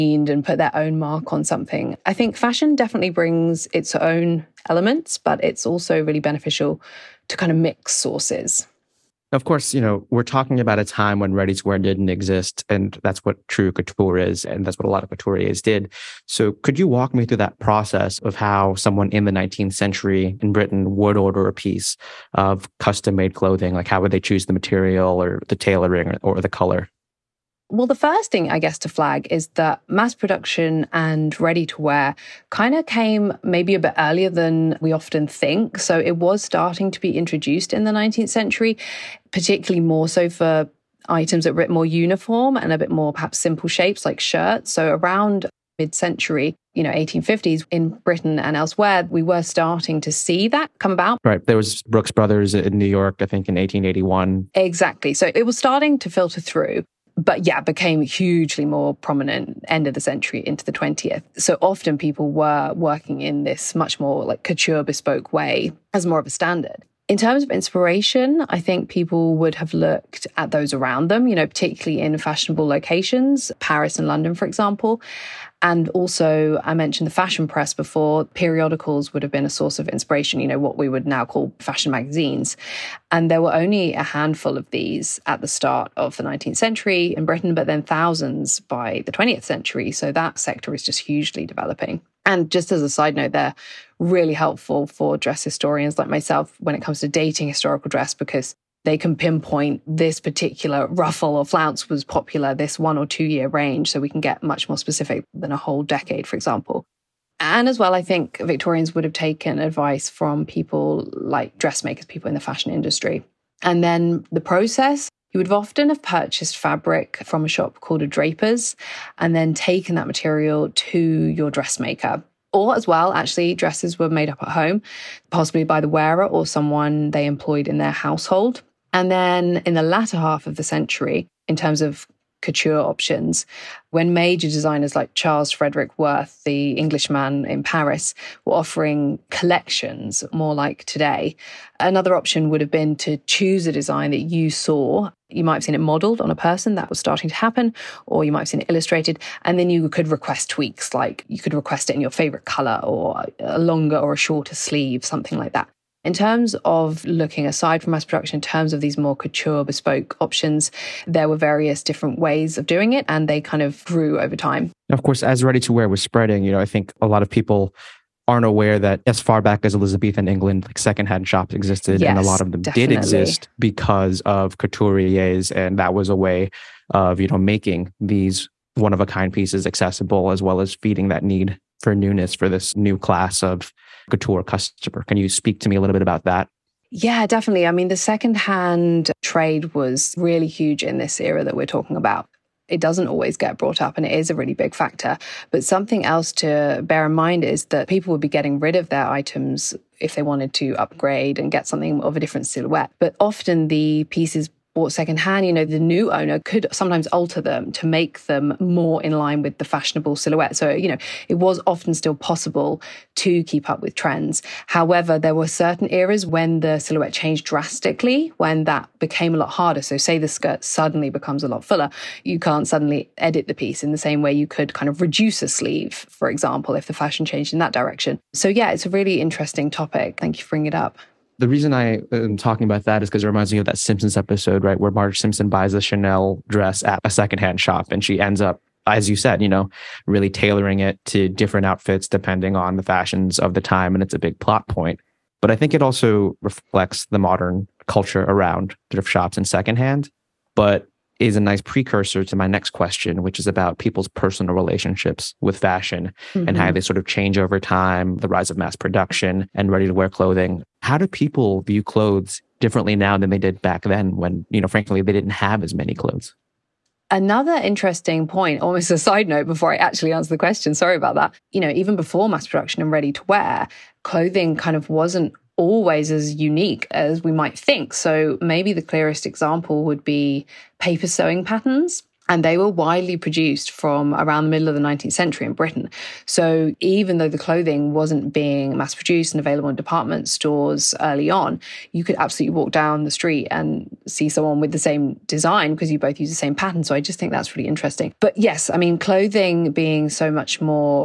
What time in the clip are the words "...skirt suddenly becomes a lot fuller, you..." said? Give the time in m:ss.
3:40.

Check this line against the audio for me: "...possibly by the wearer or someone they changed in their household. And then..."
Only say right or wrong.
wrong.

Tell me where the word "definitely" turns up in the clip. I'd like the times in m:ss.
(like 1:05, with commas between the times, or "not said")
0:02, 2:52, 3:07.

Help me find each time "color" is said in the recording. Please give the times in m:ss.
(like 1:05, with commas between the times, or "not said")
0:26, 2:32.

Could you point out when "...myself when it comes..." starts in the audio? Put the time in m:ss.
1:36.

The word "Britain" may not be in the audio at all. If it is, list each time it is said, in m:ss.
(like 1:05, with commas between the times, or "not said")
0:20, 0:47, 1:27, 4:45.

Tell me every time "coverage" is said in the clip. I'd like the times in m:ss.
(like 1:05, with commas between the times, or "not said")
not said.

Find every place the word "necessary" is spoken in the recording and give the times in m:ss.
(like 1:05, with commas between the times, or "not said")
not said.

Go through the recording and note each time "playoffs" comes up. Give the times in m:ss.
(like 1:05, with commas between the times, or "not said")
not said.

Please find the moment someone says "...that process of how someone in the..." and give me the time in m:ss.
0:17.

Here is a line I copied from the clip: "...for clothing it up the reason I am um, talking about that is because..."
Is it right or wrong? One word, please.
wrong.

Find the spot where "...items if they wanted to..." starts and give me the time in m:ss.
3:19.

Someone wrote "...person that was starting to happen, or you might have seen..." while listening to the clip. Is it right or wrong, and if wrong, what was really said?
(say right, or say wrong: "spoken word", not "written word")
right.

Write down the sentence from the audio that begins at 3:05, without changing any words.
Can you speak to me a little bit about that?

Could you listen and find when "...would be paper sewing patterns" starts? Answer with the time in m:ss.
4:39.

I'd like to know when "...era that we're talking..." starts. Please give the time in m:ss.
3:11.